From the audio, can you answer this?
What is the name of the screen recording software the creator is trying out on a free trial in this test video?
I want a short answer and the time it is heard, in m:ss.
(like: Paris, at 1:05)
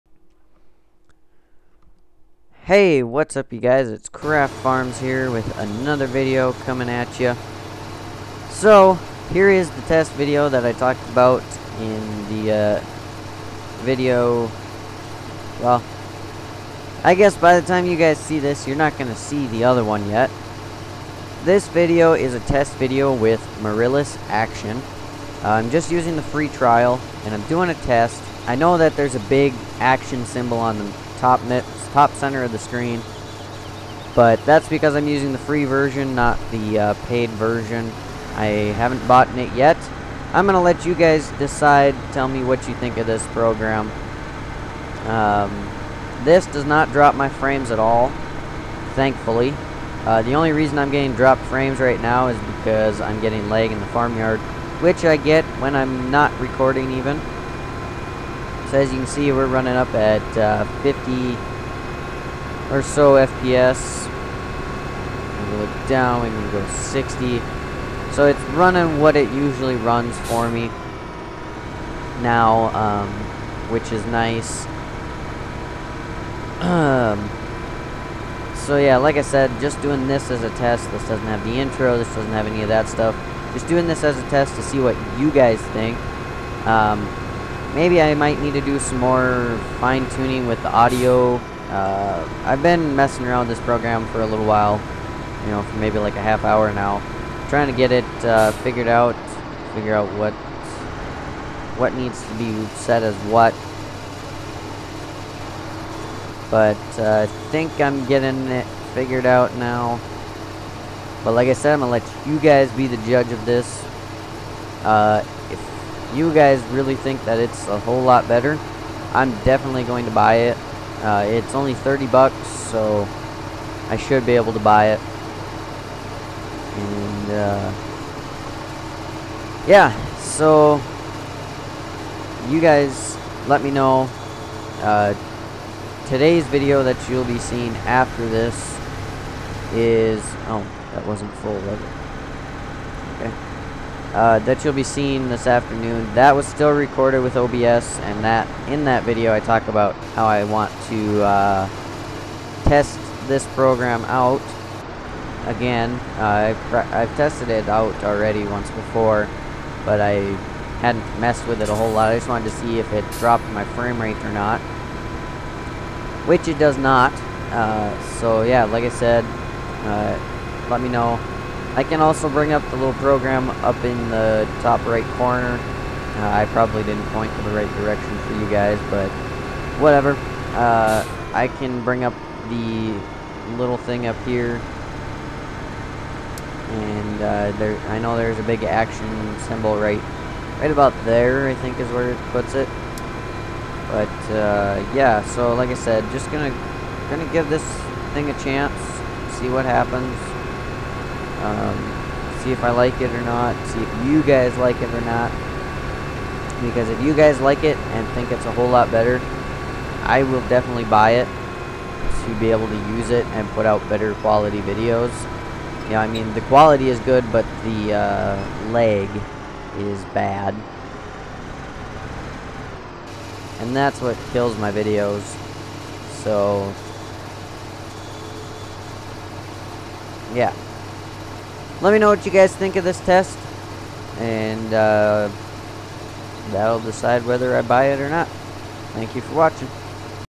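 Mirillis Action, at 0:23.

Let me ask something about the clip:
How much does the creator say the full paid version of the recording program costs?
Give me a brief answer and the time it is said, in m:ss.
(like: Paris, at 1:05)
$30, at 2:01.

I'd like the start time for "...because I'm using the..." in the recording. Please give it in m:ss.
0:34.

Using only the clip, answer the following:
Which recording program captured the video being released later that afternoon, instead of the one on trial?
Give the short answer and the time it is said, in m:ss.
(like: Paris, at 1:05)
OBS, at 2:27.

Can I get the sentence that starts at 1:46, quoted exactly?
But uh, I think I'm getting it figured out now.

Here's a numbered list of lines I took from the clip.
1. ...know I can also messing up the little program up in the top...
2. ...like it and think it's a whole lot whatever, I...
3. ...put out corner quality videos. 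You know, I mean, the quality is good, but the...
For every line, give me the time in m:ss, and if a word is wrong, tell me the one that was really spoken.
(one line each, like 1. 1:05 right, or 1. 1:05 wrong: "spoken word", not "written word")
1. 2:50 wrong: "bring", not "messing"
2. 3:27 wrong: "better", not "whatever"
3. 3:33 wrong: "better", not "corner".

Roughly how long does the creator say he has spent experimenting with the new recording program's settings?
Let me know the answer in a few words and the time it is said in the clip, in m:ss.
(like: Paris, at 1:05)
half hour, at 1:36.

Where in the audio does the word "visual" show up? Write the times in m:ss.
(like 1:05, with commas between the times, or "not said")
not said.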